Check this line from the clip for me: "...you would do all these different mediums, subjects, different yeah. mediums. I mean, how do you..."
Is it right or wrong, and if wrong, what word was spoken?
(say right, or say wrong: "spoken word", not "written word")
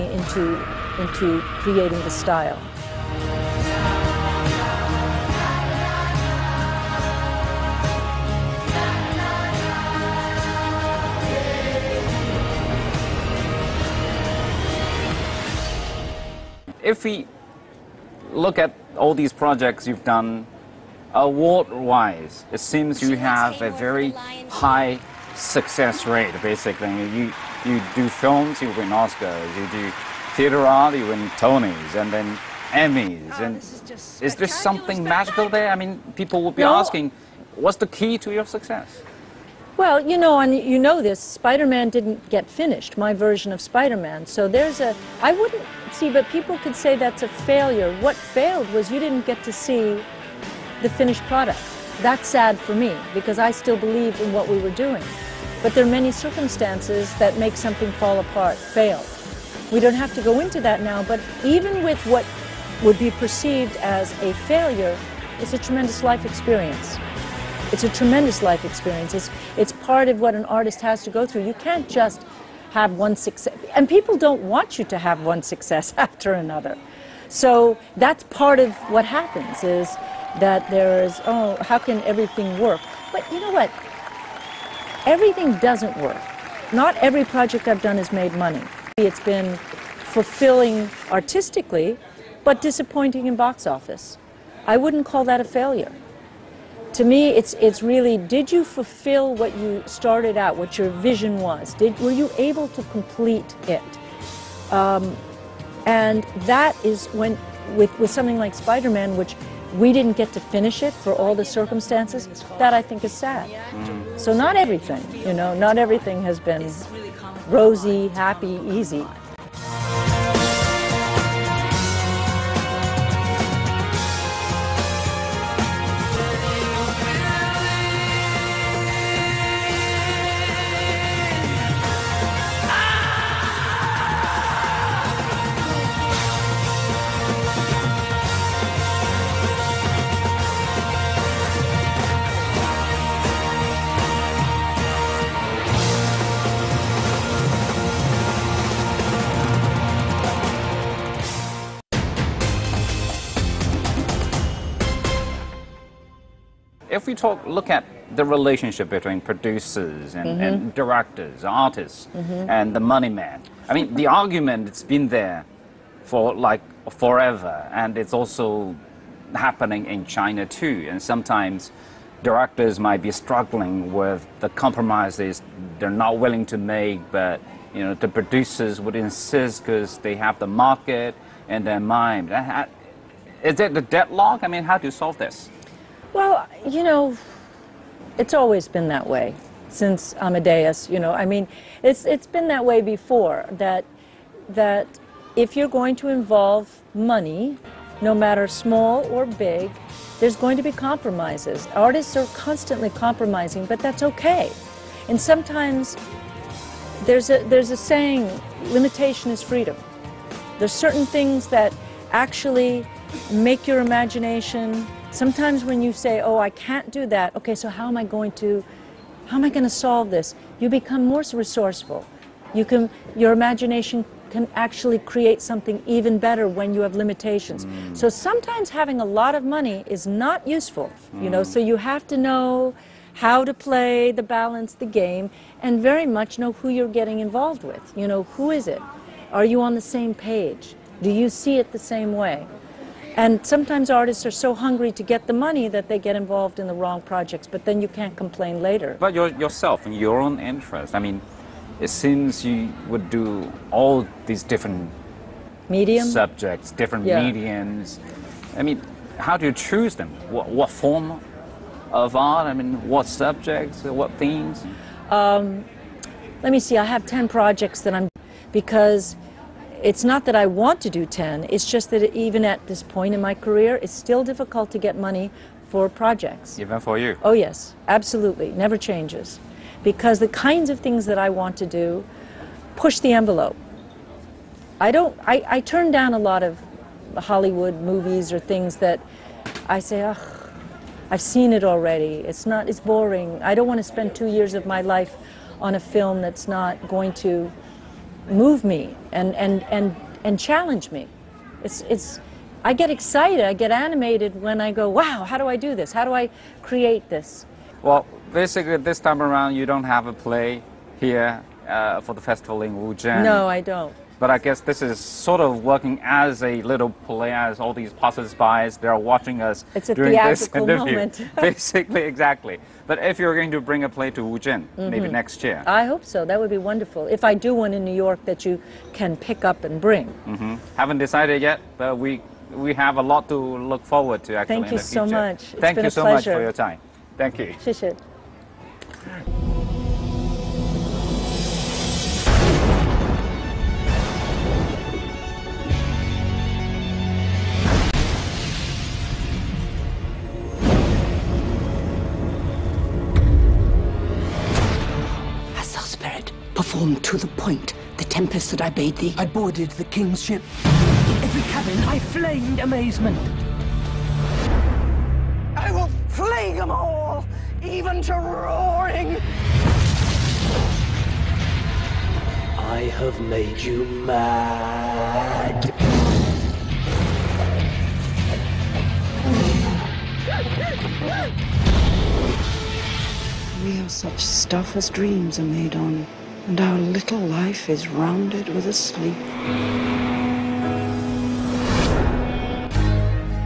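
right.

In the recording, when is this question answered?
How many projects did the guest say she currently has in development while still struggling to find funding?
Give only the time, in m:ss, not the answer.
4:27.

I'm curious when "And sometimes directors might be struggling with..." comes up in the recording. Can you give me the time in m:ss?
2:50.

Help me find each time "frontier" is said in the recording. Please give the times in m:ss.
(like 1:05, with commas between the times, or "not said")
not said.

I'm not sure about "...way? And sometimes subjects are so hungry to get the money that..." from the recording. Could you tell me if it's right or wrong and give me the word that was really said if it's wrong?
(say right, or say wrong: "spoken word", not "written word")
wrong: "artists", not "subjects".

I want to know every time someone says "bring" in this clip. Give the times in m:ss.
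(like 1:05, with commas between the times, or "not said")
5:23, 5:29.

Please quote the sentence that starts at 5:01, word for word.
It's, it's, I get excited, I get animated when I go, wow, how do I do this?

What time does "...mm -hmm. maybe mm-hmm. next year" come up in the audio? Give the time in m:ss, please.
5:24.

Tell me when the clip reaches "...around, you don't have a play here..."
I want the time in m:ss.
5:09.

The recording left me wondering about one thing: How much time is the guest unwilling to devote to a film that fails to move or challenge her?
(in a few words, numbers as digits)
Two years.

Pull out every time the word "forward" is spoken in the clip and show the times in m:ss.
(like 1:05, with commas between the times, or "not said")
5:33.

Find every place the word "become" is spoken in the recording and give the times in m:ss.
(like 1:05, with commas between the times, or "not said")
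3:40.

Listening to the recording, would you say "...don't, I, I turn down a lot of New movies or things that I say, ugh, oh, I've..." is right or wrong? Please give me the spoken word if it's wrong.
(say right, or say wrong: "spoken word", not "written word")
wrong: "Hollywood", not "New".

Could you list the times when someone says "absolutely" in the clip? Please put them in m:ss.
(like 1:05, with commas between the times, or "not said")
4:37.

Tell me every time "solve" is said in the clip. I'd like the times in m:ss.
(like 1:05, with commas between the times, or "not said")
3:05, 3:39.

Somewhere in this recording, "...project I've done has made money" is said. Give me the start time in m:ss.
1:27.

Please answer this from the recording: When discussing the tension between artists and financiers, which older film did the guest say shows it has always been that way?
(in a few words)
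Amadeus.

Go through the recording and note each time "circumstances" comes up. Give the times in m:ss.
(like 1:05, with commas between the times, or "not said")
0:56, 1:51.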